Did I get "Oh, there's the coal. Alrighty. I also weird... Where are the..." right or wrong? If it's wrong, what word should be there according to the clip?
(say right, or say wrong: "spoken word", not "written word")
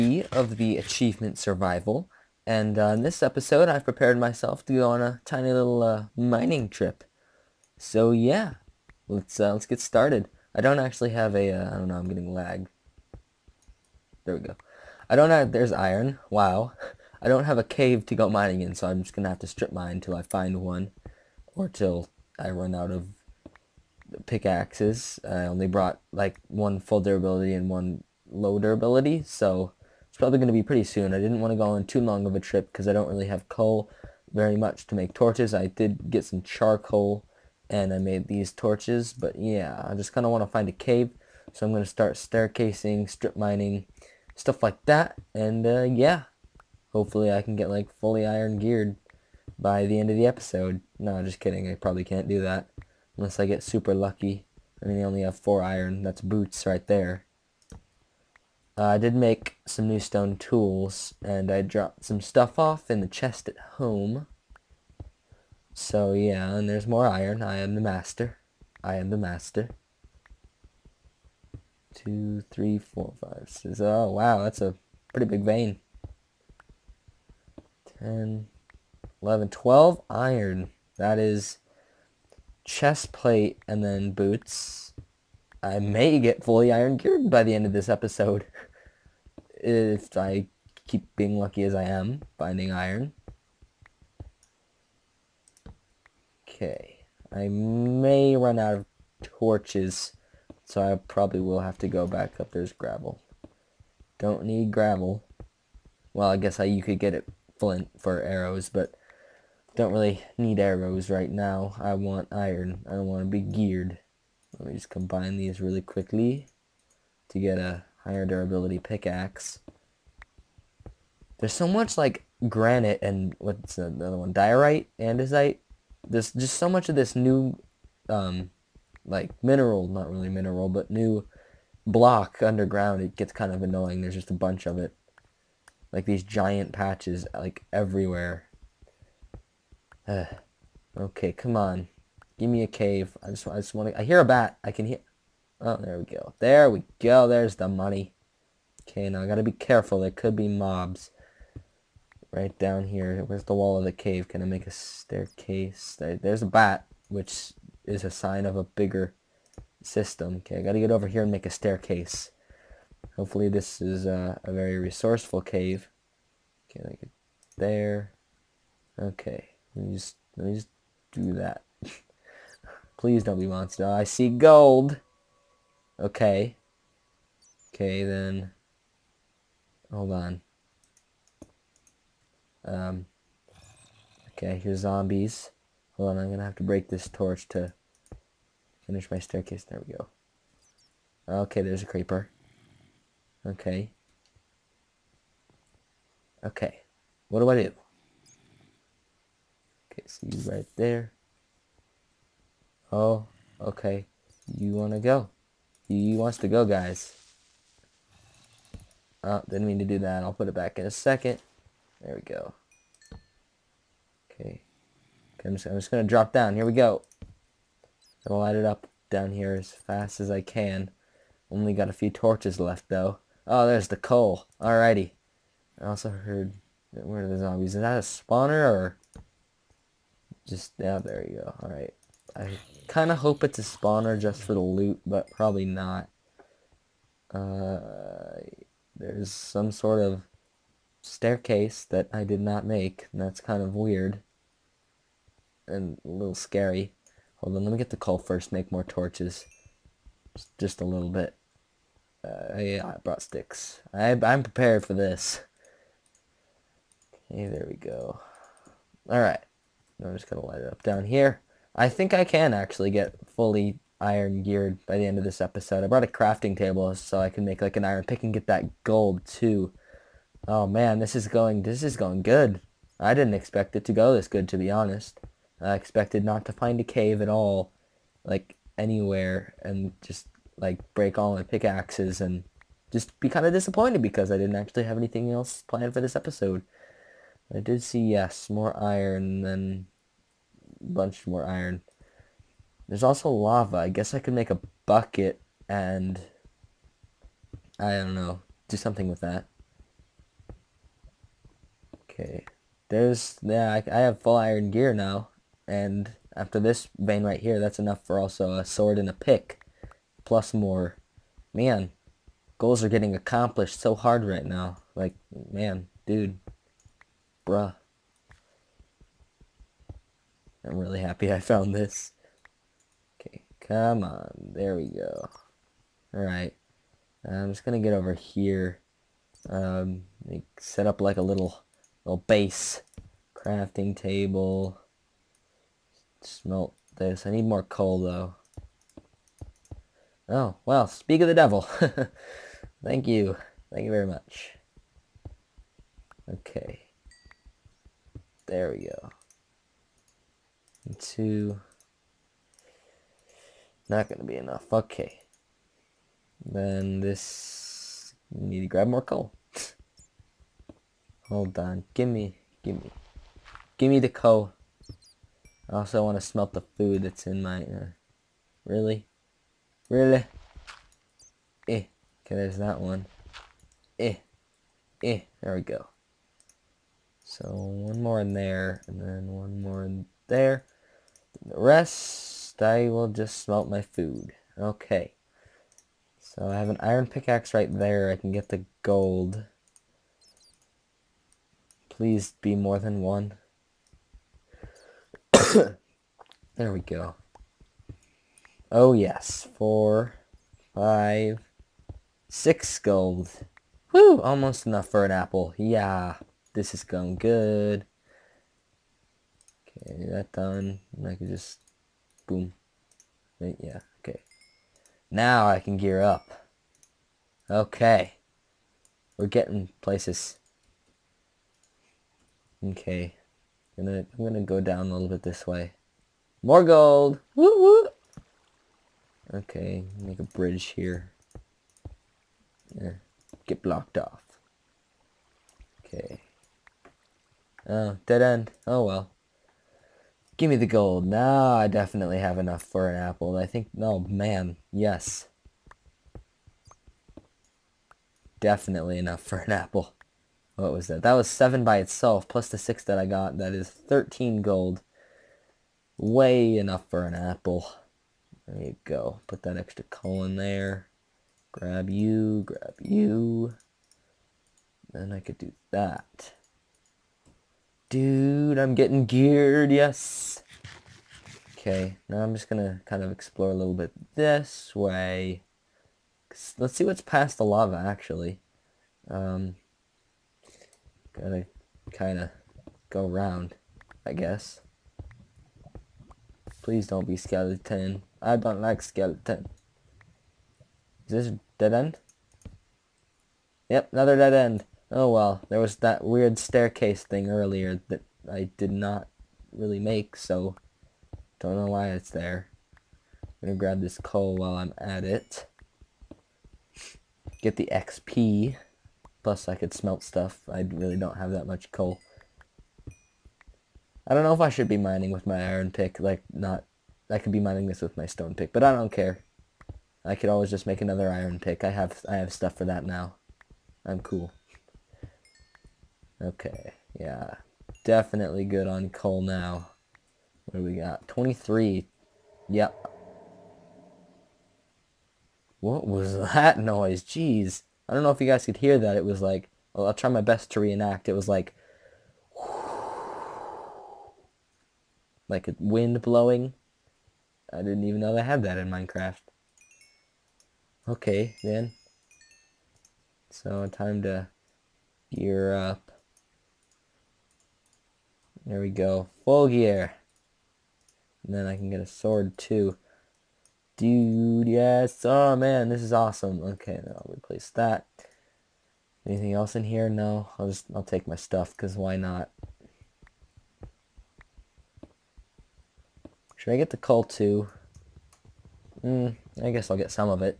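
wrong: "heard", not "weird".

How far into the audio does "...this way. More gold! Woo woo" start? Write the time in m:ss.
7:05.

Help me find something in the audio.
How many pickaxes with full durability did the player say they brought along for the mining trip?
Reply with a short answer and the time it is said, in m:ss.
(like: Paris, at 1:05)
1, at 0:26.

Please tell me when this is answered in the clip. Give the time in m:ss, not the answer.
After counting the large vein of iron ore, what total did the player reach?
1:17.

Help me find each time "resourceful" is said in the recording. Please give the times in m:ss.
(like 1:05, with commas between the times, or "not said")
2:44.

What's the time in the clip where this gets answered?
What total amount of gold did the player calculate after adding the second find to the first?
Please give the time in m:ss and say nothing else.
7:33.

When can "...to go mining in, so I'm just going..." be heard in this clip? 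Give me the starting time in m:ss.
0:18.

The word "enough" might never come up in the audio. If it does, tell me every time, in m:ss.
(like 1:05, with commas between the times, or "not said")
5:07, 5:54, 6:44, 7:22, 7:28, 7:36.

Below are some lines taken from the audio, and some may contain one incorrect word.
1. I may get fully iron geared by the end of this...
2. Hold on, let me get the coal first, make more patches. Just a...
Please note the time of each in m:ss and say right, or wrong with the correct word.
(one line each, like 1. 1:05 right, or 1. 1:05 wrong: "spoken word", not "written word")
1. 1:25 right
2. 4:07 wrong: "torches", not "patches".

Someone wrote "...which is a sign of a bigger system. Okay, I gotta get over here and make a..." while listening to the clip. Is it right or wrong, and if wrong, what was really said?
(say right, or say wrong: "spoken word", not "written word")
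right.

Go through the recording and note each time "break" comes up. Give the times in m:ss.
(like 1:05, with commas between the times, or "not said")
3:06, 4:40.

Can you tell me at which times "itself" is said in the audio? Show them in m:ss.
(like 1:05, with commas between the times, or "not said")
7:31.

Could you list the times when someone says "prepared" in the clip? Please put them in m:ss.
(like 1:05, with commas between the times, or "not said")
0:03, 4:14.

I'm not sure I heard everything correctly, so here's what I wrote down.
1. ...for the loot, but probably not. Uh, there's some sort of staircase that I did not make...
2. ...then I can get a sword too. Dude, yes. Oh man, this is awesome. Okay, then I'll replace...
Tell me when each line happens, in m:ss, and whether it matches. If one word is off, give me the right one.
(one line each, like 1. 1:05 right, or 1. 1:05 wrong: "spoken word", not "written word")
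1. 3:54 right
2. 9:21 right.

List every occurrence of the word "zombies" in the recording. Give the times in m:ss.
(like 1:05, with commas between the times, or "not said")
3:04, 3:47.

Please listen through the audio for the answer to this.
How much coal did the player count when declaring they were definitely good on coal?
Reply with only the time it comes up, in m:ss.
8:51.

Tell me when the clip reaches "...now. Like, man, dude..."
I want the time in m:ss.
5:14.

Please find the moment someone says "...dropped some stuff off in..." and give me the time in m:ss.
1:01.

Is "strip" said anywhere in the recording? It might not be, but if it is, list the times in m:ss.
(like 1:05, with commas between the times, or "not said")
0:19, 0:43.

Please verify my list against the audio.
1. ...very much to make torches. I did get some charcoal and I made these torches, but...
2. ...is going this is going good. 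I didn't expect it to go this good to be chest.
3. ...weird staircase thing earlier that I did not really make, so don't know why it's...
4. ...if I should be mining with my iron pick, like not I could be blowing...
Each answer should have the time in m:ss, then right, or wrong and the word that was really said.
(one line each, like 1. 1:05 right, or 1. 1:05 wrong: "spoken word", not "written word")
1. 0:34 right
2. 4:31 wrong: "honest", not "chest"
3. 8:16 right
4. 8:34 wrong: "mining", not "blowing".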